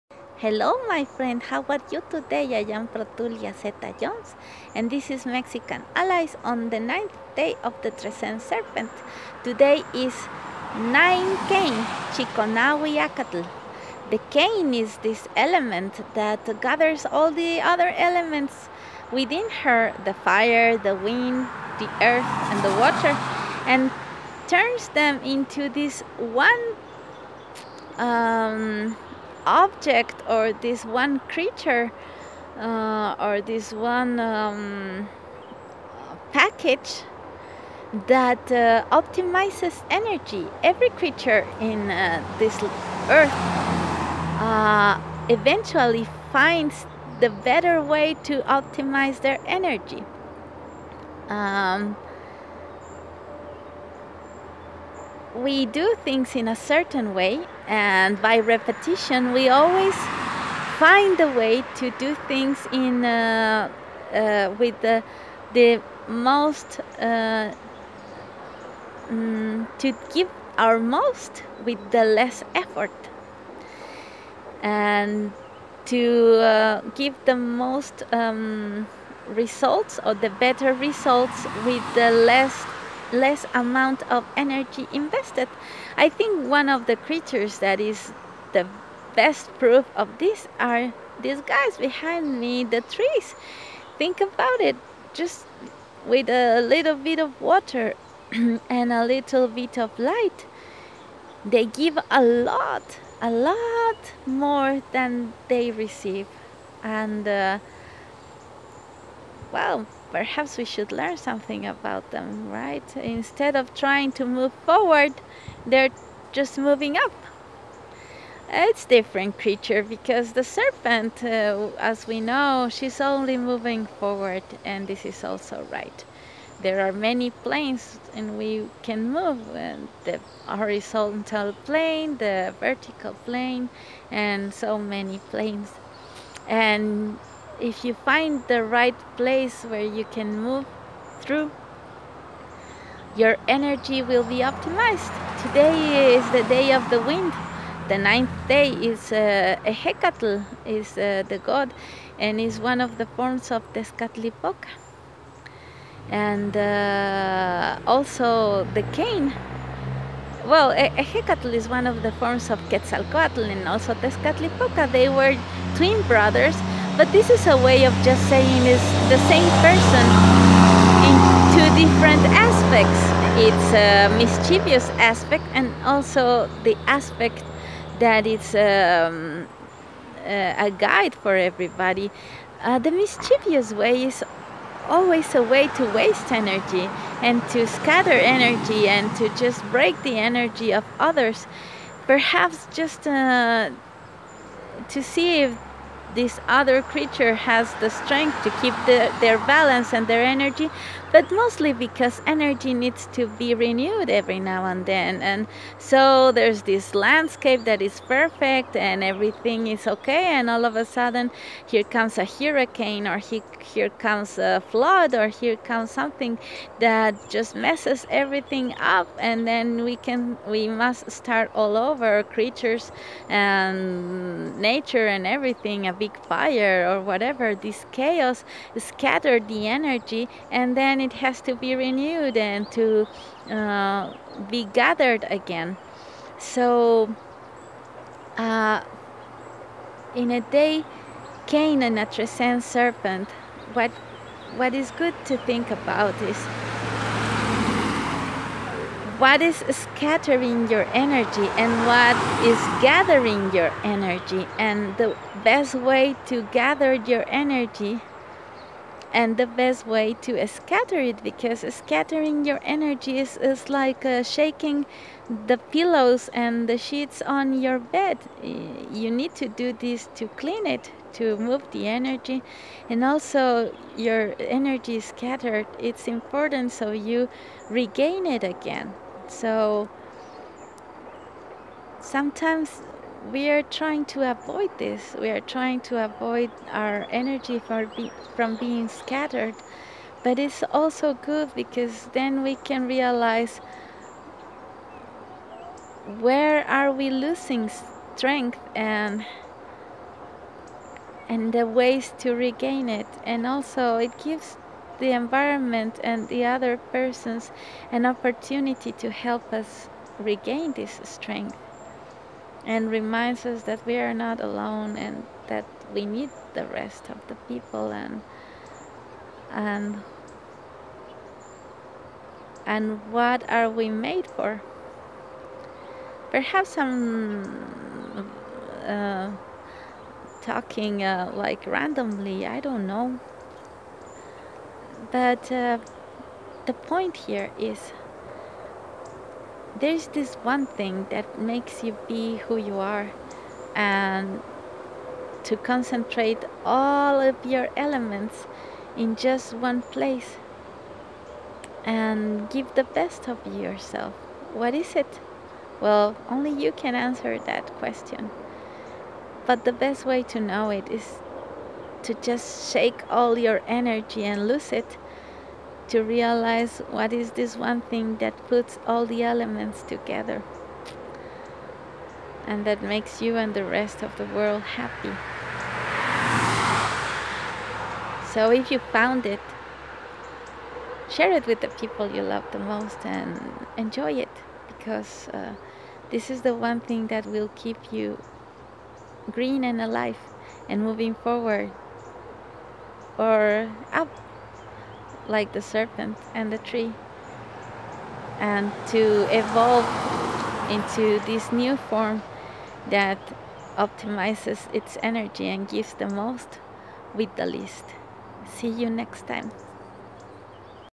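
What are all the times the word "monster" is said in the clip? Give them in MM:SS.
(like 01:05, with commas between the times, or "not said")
not said.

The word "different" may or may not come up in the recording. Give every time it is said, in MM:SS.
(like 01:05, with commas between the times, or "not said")
01:58, 02:51.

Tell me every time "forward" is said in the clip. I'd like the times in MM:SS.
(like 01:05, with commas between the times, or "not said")
01:54, 02:03, 06:31.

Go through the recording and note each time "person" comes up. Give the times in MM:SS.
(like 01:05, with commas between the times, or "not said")
02:49, 05:06.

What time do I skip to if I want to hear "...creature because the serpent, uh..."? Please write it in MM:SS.
01:59.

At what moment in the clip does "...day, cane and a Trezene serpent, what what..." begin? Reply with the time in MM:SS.
04:00.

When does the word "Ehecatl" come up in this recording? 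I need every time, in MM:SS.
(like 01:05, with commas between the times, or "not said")
02:29, 02:40.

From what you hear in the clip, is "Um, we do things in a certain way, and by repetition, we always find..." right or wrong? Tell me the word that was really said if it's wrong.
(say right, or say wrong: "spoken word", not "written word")
right.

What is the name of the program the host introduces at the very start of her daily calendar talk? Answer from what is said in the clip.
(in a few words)
Mexican Allies.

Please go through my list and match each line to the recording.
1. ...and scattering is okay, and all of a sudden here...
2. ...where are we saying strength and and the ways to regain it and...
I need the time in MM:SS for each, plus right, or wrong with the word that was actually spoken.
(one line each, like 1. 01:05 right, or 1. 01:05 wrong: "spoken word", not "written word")
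1. 03:28 wrong: "everything", not "scattering"
2. 04:56 wrong: "losing", not "saying".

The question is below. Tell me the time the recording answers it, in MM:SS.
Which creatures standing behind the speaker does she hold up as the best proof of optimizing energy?
01:32.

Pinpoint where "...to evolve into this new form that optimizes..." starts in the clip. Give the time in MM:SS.
06:38.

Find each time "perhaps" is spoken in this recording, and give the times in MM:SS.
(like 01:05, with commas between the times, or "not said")
01:50, 03:12, 05:26.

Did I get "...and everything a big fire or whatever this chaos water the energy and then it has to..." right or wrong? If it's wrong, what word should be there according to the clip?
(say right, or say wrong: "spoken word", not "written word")
wrong: "scatter", not "water".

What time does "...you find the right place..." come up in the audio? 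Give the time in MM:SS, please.
02:17.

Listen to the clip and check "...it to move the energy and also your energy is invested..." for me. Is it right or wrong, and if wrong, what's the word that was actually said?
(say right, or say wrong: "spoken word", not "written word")
wrong: "scattered", not "invested".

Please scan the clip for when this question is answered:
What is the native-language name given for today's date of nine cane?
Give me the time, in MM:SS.
00:12.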